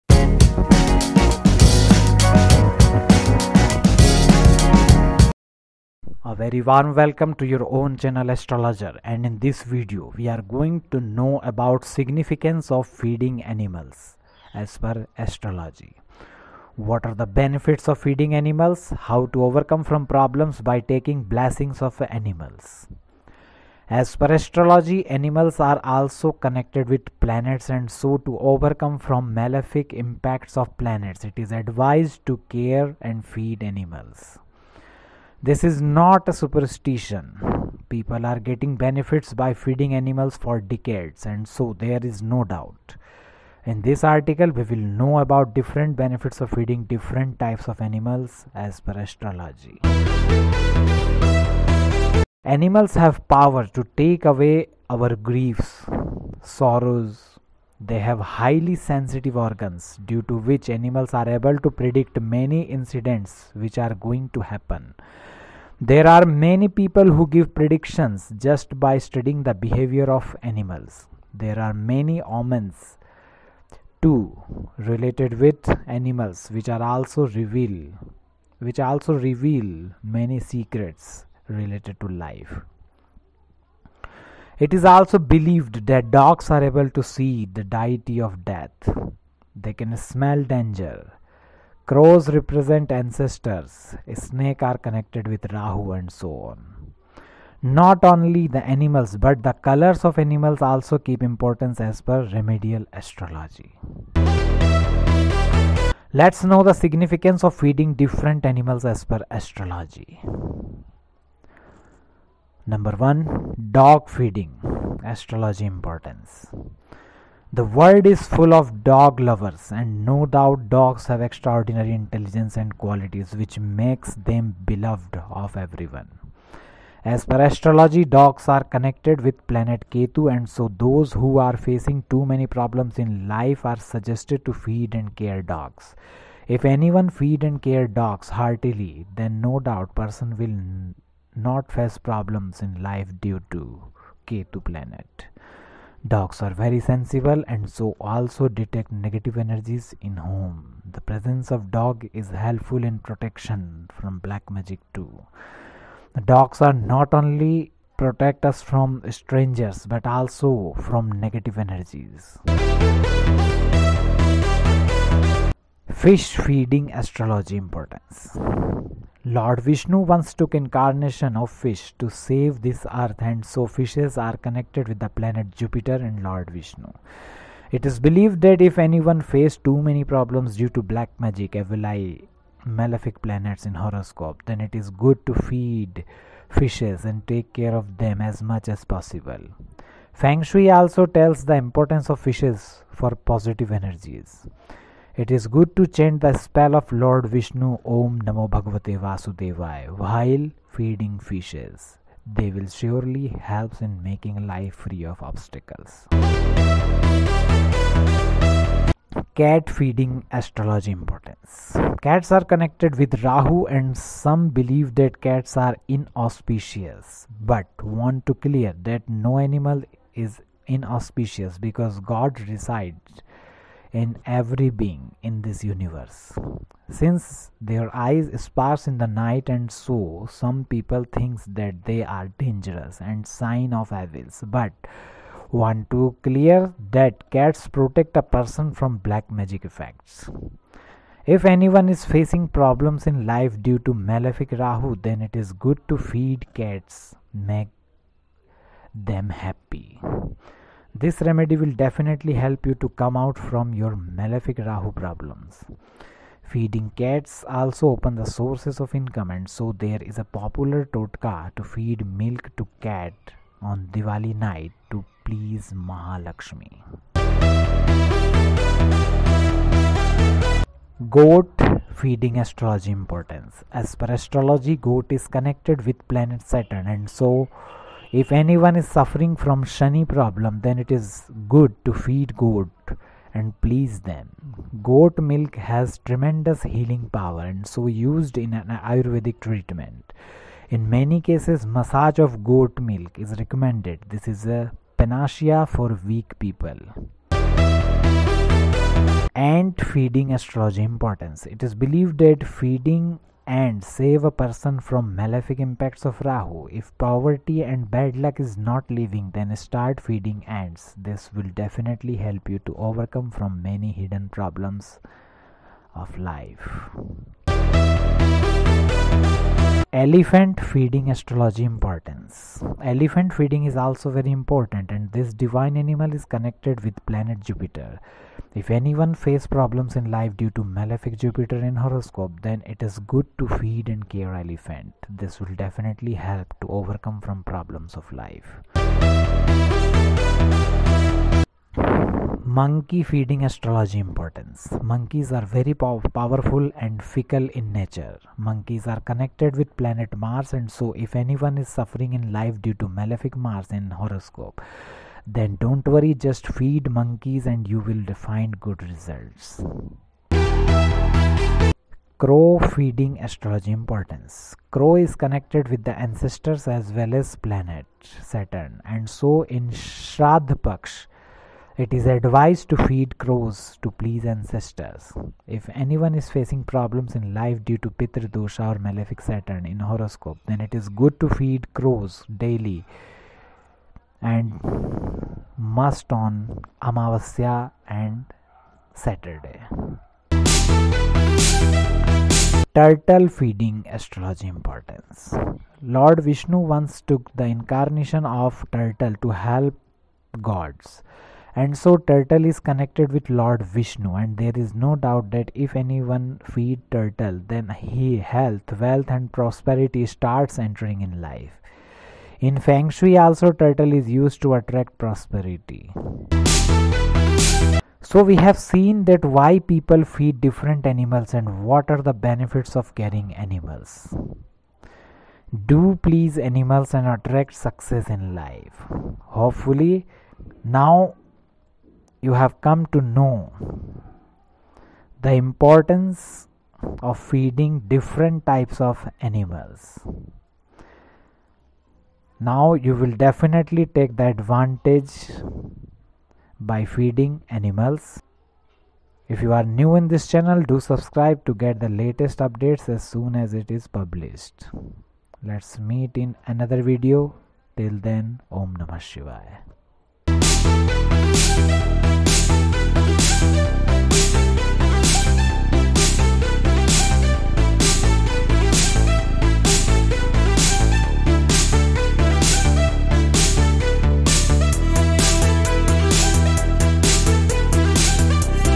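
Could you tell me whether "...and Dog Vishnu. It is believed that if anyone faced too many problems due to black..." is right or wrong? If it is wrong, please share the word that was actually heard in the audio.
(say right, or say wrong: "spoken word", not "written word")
wrong: "Lord", not "Dog".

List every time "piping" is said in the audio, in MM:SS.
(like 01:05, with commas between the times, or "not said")
not said.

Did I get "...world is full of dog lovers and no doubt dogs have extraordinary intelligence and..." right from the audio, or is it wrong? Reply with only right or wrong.
right.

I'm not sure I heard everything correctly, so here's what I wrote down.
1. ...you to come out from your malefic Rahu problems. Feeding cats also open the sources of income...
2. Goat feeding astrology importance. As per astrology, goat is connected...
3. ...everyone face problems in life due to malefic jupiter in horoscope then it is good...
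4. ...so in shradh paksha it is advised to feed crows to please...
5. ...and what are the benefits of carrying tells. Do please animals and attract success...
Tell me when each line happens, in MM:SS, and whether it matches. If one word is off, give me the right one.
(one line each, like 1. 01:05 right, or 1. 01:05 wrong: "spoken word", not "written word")
1. 04:12 right
2. 04:31 right
3. 05:28 wrong: "anyone", not "everyone"
4. 06:09 right
5. 07:01 wrong: "animals", not "tells".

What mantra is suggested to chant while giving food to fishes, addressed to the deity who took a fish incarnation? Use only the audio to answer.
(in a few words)
Om Namo Bhagavate Vasudevaya.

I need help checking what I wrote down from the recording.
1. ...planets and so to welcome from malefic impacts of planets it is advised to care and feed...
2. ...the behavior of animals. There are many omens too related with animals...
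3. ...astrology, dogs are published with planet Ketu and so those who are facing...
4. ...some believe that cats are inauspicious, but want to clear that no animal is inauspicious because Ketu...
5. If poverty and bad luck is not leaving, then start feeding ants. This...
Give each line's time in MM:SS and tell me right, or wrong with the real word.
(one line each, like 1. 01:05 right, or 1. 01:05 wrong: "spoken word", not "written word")
1. 00:27 wrong: "overcome", not "welcome"
2. 01:09 right
3. 02:07 wrong: "connected", not "published"
4. 03:33 wrong: "God", not "Ketu"
5. 05:06 right.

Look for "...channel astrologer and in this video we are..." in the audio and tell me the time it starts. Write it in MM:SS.
00:08.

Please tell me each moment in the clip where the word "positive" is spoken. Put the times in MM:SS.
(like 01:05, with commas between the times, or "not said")
03:13.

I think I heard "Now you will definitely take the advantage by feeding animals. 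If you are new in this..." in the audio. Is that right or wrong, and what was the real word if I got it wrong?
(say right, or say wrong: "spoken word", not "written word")
right.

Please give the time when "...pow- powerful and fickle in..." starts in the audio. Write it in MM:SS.
05:45.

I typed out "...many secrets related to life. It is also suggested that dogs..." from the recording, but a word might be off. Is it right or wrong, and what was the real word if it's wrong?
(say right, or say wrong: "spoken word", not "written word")
wrong: "believed", not "suggested".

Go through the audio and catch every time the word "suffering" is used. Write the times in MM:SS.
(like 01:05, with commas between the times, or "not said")
04:38, 05:51.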